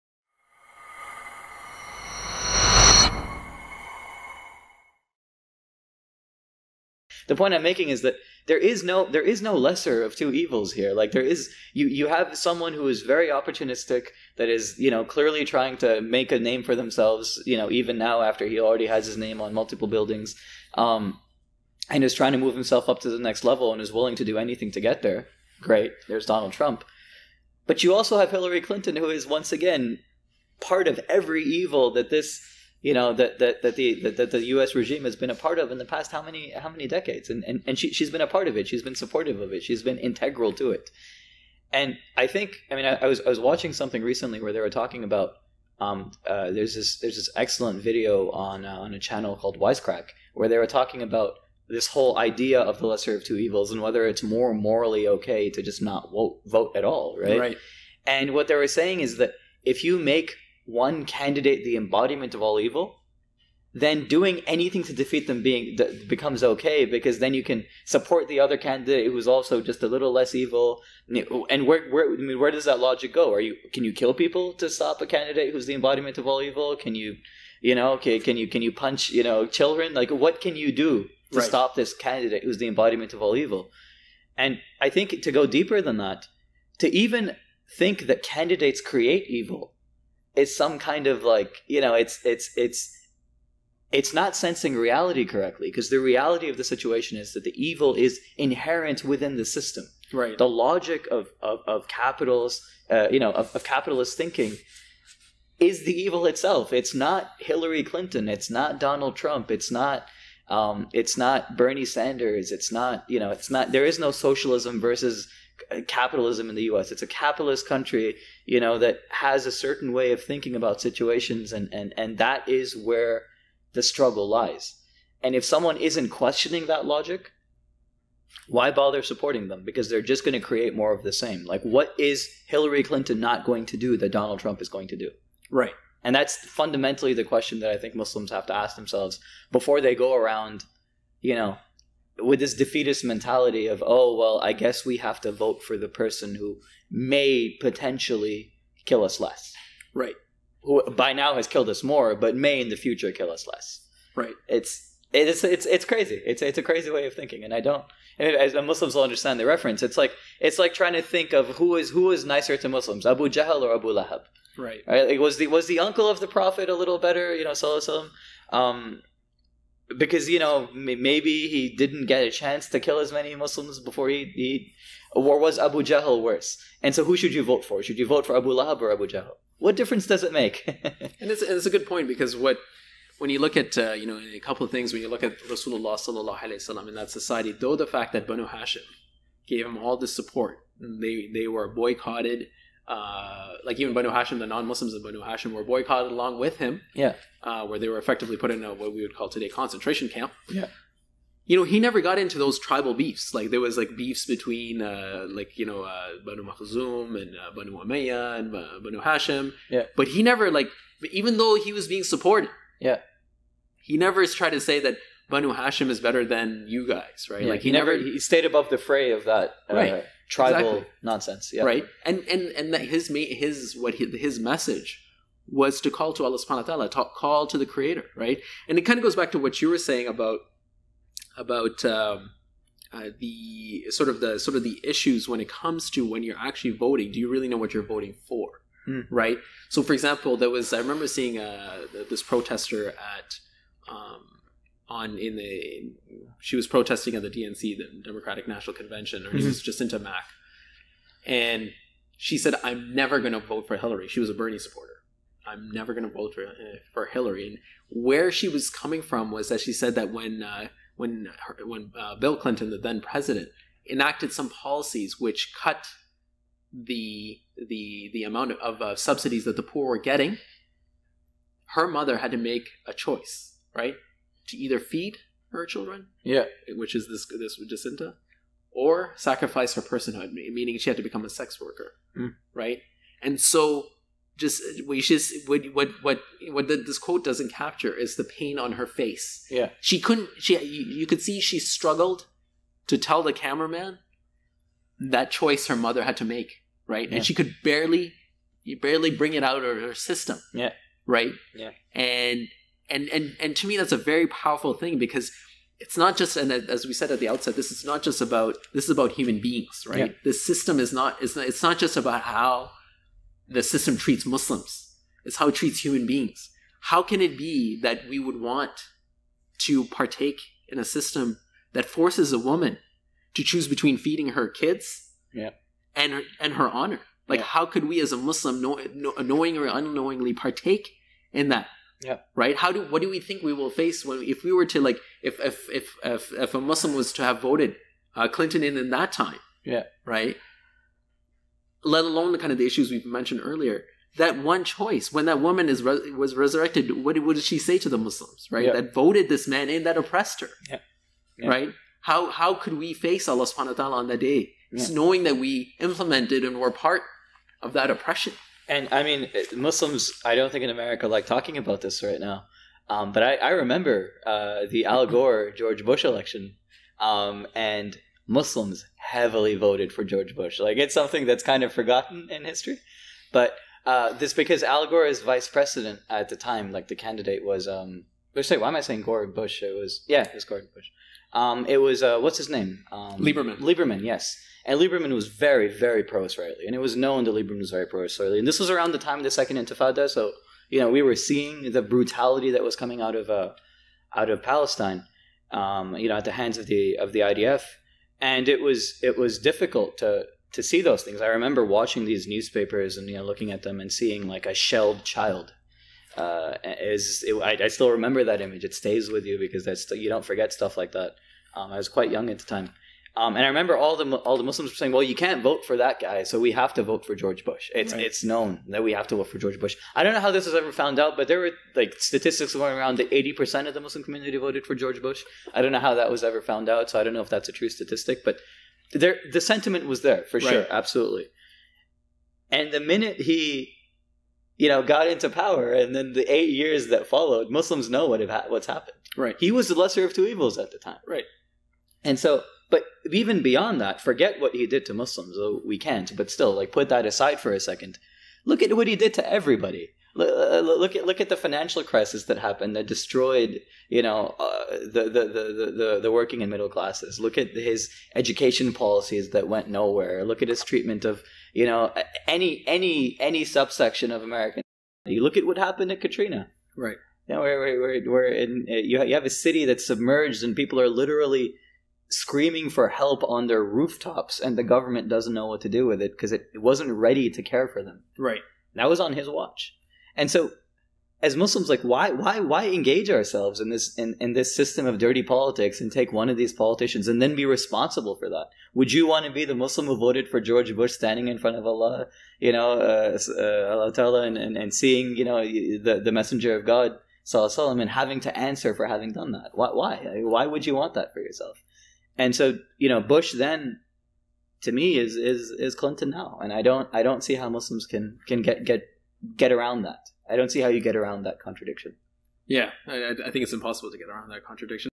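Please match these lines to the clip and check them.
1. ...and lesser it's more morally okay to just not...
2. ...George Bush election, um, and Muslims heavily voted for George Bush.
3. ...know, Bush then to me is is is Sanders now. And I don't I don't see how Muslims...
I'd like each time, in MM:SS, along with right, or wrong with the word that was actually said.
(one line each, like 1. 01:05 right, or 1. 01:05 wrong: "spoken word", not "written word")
1. 00:53 wrong: "whether", not "lesser"
2. 06:05 right
3. 08:22 wrong: "Clinton", not "Sanders".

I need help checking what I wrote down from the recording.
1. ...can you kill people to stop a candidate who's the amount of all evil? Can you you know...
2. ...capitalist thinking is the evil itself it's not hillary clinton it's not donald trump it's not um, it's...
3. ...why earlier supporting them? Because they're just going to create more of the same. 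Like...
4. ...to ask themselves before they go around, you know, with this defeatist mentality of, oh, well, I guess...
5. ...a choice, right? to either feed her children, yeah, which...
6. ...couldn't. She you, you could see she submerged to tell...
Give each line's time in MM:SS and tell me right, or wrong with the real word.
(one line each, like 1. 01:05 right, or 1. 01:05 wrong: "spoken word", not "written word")
1. 01:13 wrong: "embodiment", not "amount"
2. 01:43 right
3. 02:08 wrong: "bother", not "earlier"
4. 02:18 right
5. 04:32 right
6. 04:49 wrong: "struggled", not "submerged".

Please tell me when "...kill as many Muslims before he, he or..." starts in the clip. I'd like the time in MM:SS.
02:52.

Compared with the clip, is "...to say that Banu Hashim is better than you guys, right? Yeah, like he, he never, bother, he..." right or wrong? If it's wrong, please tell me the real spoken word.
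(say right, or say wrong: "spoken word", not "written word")
wrong: "never", not "bother".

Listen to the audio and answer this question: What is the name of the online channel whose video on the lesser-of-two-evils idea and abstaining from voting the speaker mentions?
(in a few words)
Wisecrack.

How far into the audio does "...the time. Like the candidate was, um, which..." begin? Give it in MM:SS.
06:16.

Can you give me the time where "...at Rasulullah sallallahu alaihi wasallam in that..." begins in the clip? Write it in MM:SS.
03:05.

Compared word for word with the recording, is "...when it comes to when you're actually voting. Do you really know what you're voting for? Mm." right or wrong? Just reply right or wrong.
right.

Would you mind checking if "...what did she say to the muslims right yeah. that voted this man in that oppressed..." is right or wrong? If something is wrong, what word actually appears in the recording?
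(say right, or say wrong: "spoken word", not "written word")
right.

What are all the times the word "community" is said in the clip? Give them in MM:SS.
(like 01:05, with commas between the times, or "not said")
07:04.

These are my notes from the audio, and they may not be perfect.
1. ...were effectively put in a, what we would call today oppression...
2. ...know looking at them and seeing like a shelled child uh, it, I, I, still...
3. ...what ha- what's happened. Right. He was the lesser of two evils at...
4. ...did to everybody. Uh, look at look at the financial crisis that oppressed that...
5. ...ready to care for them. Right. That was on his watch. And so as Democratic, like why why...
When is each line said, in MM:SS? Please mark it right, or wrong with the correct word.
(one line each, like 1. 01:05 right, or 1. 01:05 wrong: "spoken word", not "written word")
1. 03:17 wrong: "concentration", not "oppression"
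2. 06:43 right
3. 07:18 right
4. 07:28 wrong: "happened", not "oppressed"
5. 07:56 wrong: "Muslims", not "Democratic".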